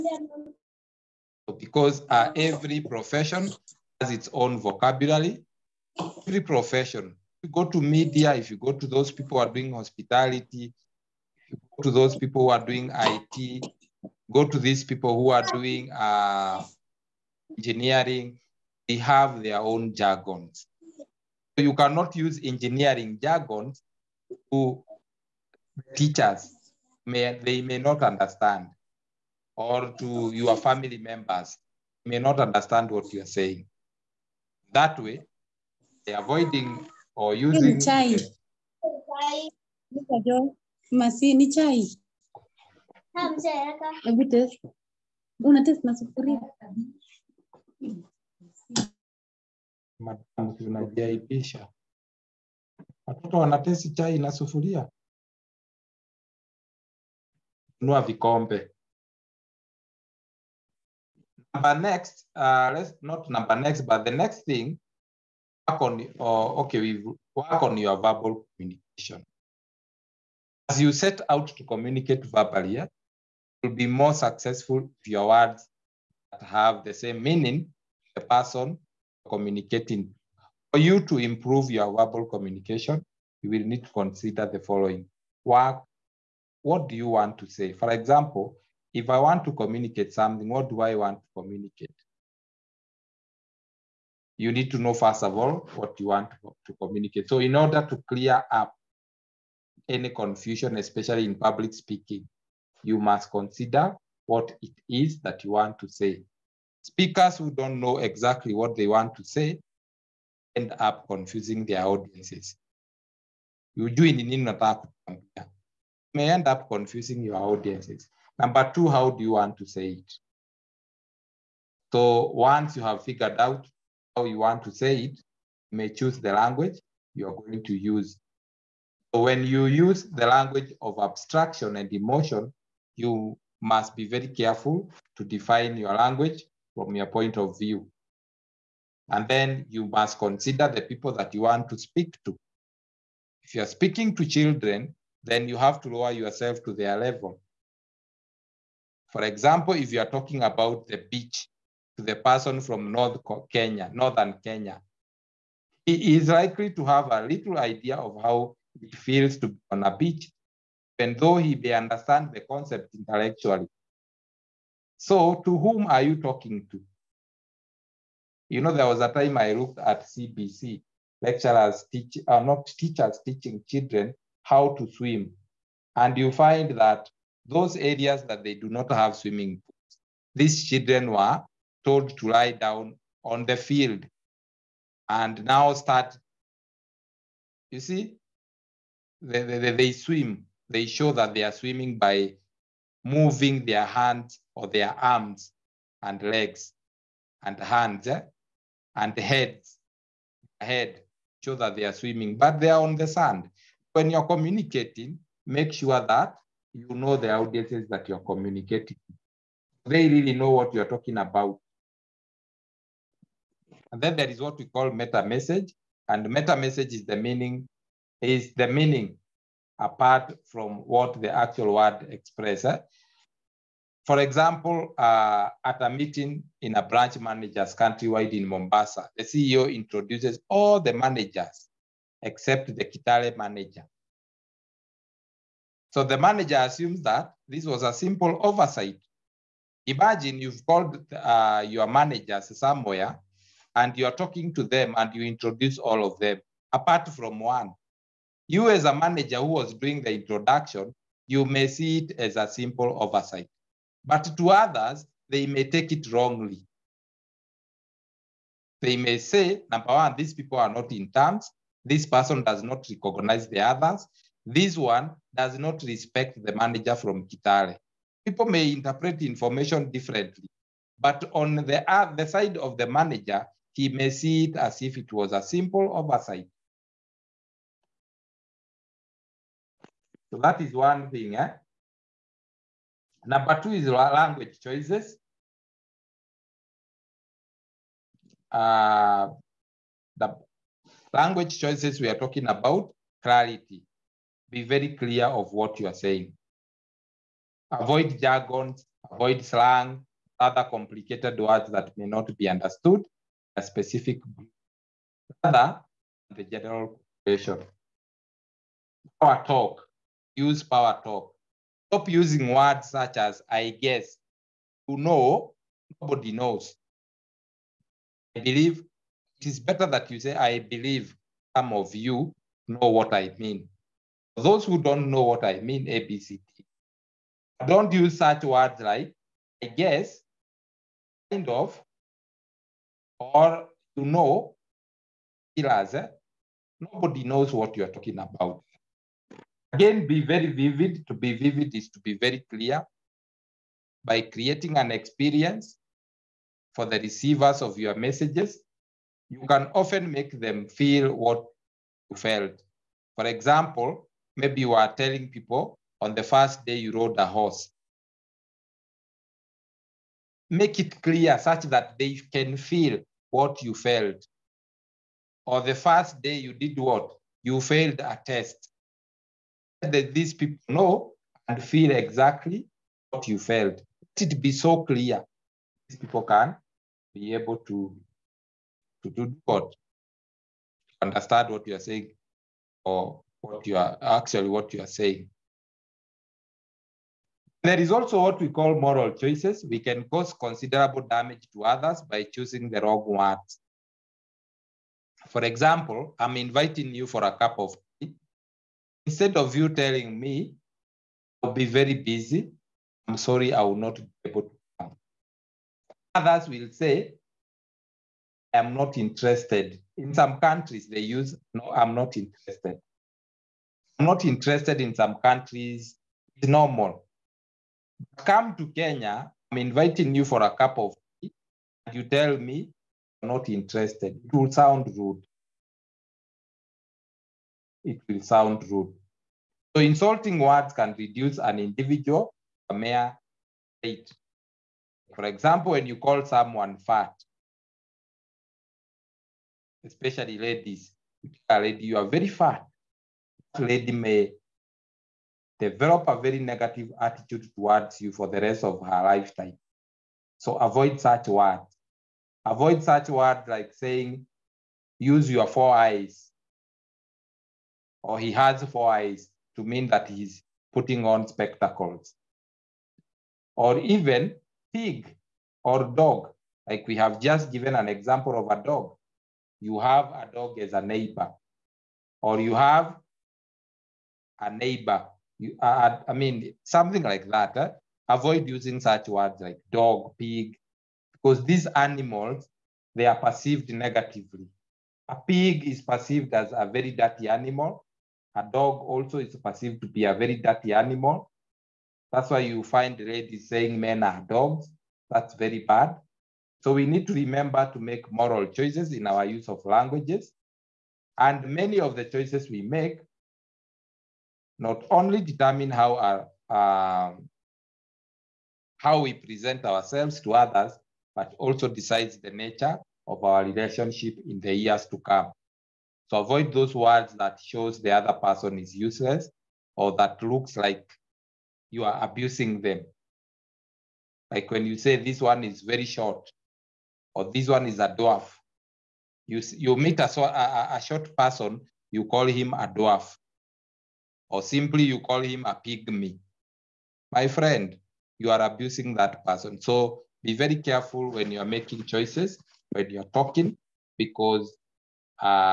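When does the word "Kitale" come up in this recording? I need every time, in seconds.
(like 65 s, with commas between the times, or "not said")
232 s, 267 s.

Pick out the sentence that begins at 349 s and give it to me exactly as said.
You can often make them feel what you felt.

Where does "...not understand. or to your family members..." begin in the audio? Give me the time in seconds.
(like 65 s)
27 s.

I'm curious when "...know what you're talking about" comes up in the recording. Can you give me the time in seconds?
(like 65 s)
210 s.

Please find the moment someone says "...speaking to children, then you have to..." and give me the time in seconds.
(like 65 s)
143 s.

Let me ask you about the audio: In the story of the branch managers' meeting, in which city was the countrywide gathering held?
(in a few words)
Mombasa.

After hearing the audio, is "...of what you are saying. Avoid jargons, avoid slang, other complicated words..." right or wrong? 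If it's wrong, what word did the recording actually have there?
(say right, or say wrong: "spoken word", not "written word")
right.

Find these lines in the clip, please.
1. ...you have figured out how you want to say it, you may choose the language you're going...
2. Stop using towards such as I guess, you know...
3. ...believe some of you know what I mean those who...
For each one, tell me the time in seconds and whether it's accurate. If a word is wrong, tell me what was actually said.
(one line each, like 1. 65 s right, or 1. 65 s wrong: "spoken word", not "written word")
1. 122 s right
2. 311 s wrong: "words", not "towards"
3. 320 s right.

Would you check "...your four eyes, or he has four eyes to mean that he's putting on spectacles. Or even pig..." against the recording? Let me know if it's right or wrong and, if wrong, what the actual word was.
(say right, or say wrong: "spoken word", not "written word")
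right.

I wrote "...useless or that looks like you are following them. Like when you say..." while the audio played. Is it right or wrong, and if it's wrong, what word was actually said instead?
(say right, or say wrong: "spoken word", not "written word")
wrong: "abusing", not "following".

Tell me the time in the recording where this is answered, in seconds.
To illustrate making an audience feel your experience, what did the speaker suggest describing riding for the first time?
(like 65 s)
356 s.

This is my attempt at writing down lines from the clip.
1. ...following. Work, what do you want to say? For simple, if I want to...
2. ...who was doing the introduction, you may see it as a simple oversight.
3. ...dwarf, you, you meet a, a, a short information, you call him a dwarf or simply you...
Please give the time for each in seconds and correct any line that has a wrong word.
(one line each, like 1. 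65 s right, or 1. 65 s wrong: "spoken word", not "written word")
1. 84 s wrong: "example", not "simple"
2. 249 s right
3. 527 s wrong: "person", not "information".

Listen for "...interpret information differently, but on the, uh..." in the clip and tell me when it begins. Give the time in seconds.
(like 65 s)
268 s.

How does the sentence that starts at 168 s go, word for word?
You know, there was a time I looked at CBC, lecturers teach, uh, not teachers teaching children how to swim.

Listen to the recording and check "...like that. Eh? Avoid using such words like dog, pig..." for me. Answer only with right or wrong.
right.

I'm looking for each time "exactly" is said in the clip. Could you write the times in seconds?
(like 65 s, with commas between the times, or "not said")
107 s, 371 s.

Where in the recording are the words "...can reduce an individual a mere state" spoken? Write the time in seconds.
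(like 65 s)
430 s.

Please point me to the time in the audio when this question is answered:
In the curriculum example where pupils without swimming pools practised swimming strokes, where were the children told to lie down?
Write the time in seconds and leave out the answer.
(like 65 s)
183 s.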